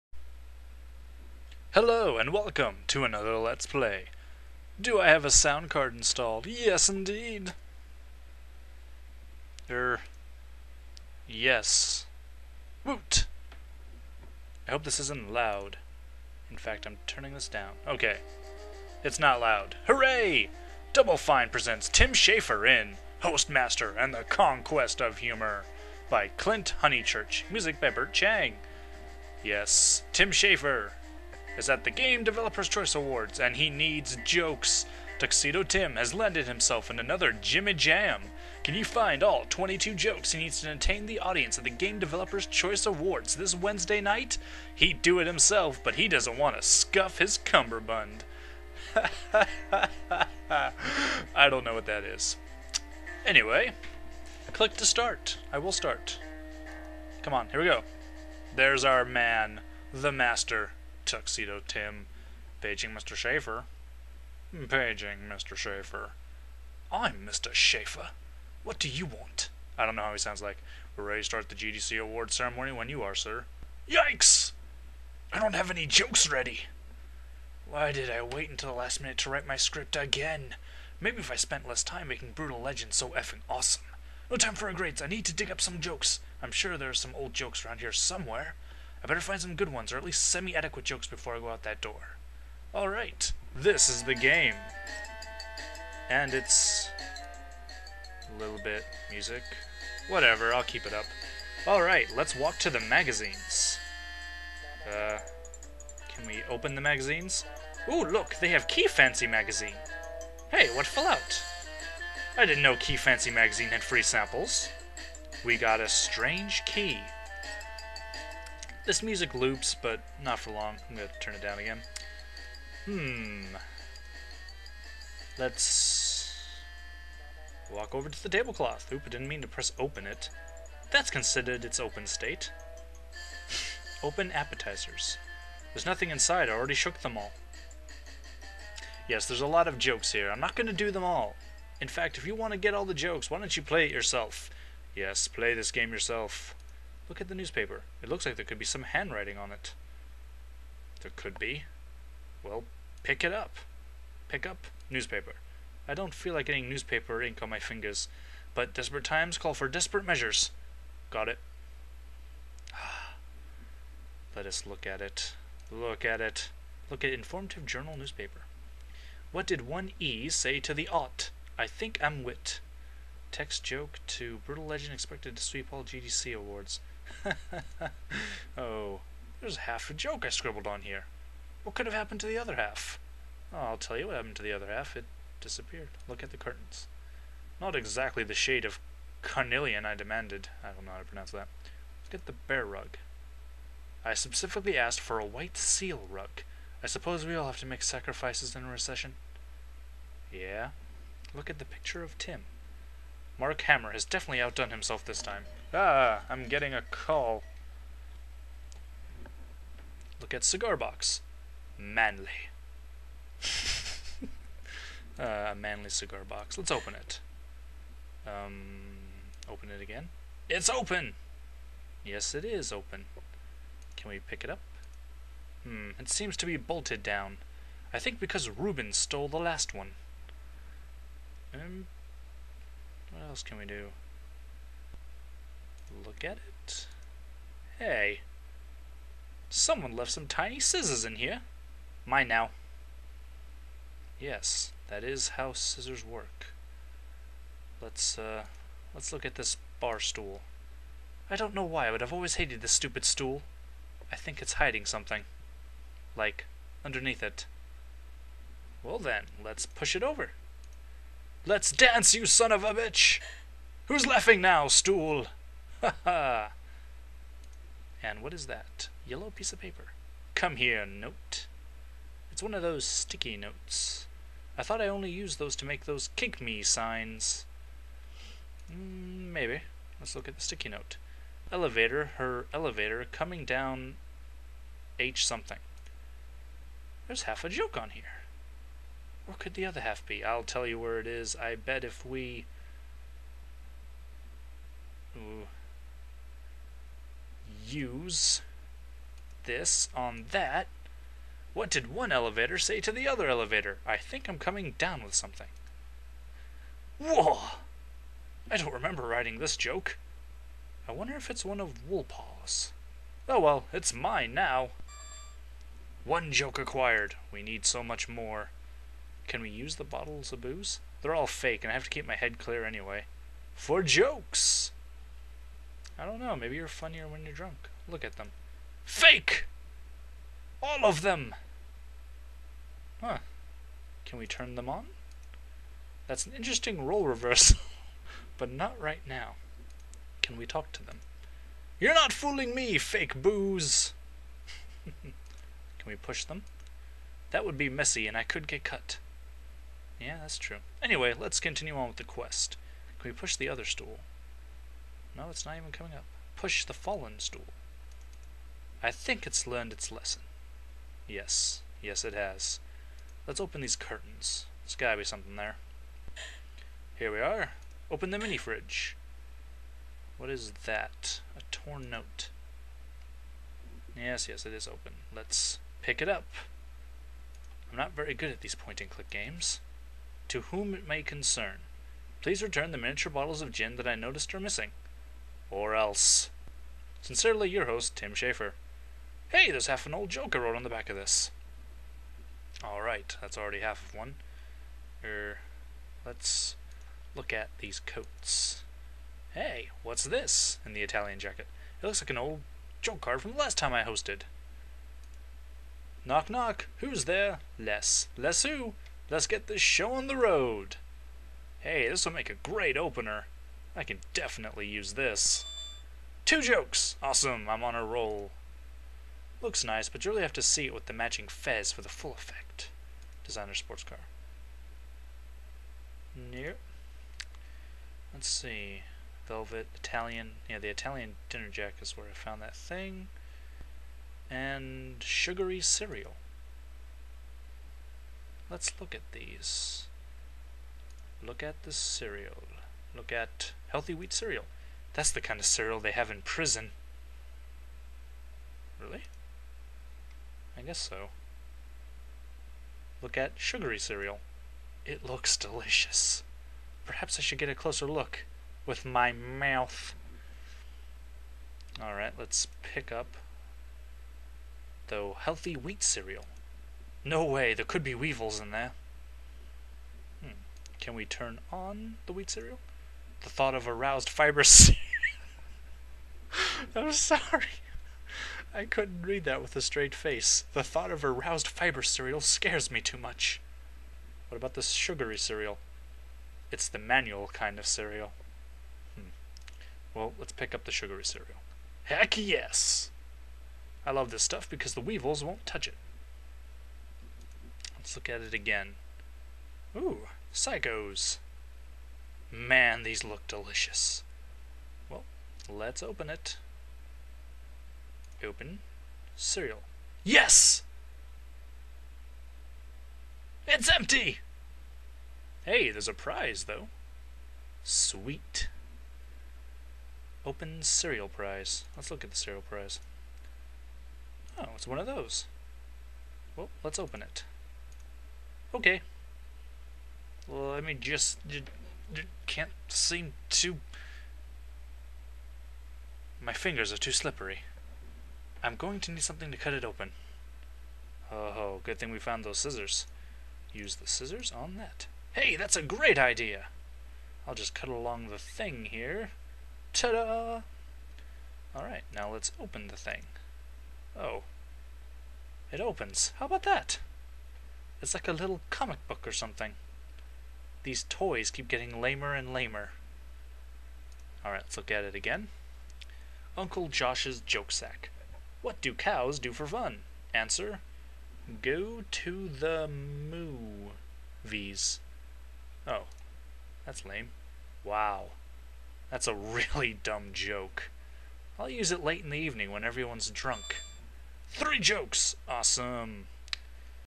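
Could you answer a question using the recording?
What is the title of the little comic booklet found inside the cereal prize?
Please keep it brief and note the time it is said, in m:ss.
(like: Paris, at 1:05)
Uncle Josh's Joke Sack, at 9:26.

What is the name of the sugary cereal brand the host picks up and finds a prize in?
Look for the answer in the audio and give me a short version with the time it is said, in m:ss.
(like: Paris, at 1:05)
Psychos, at 8:20.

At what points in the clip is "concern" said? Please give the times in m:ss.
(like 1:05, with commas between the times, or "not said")
6:21.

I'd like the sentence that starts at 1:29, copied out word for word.
I better find some good ones, or at least semi adequate jokes before I go out that door.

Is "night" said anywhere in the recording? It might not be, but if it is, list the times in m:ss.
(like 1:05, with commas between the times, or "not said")
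0:44.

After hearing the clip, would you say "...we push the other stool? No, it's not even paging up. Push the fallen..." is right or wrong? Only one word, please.
wrong.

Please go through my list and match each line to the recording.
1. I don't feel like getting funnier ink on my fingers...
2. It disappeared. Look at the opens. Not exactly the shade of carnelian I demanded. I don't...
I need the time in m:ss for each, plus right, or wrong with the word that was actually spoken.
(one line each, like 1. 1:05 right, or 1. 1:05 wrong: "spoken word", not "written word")
1. 2:35 wrong: "newspaper", not "funnier"
2. 3:04 wrong: "curtains", not "opens".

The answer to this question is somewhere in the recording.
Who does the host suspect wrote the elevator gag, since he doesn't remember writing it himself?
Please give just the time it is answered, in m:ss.
5:11.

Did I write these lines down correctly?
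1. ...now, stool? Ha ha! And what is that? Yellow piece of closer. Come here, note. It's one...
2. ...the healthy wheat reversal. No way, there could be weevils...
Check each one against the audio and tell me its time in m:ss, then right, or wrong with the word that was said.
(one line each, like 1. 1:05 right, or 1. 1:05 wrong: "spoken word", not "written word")
1. 4:24 wrong: "paper", not "closer"
2. 7:44 wrong: "cereal", not "reversal".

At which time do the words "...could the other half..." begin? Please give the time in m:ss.
4:49.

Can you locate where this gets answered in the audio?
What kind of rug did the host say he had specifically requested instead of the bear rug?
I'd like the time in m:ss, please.
3:15.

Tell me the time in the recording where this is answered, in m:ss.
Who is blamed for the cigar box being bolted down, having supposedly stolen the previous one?
3:48.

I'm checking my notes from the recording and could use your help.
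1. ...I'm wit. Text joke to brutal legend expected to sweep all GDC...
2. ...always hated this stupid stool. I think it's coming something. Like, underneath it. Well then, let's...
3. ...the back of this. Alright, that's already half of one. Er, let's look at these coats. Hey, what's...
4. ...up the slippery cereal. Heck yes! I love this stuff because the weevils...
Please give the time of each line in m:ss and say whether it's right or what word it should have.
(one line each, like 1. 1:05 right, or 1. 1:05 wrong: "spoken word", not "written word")
1. 2:52 right
2. 4:12 wrong: "hiding", not "coming"
3. 6:30 right
4. 8:10 wrong: "sugary", not "slippery".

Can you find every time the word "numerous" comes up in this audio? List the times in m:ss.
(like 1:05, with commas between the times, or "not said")
not said.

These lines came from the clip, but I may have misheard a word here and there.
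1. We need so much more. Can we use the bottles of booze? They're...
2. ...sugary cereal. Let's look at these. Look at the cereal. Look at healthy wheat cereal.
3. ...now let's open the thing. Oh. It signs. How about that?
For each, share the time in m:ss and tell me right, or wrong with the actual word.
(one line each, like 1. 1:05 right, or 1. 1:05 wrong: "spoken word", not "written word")
1. 5:17 right
2. 7:15 right
3. 9:11 wrong: "opens", not "signs".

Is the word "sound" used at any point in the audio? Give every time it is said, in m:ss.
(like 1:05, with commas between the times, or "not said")
0:05, 1:10.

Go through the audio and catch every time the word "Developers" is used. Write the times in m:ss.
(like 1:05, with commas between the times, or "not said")
0:32, 0:41.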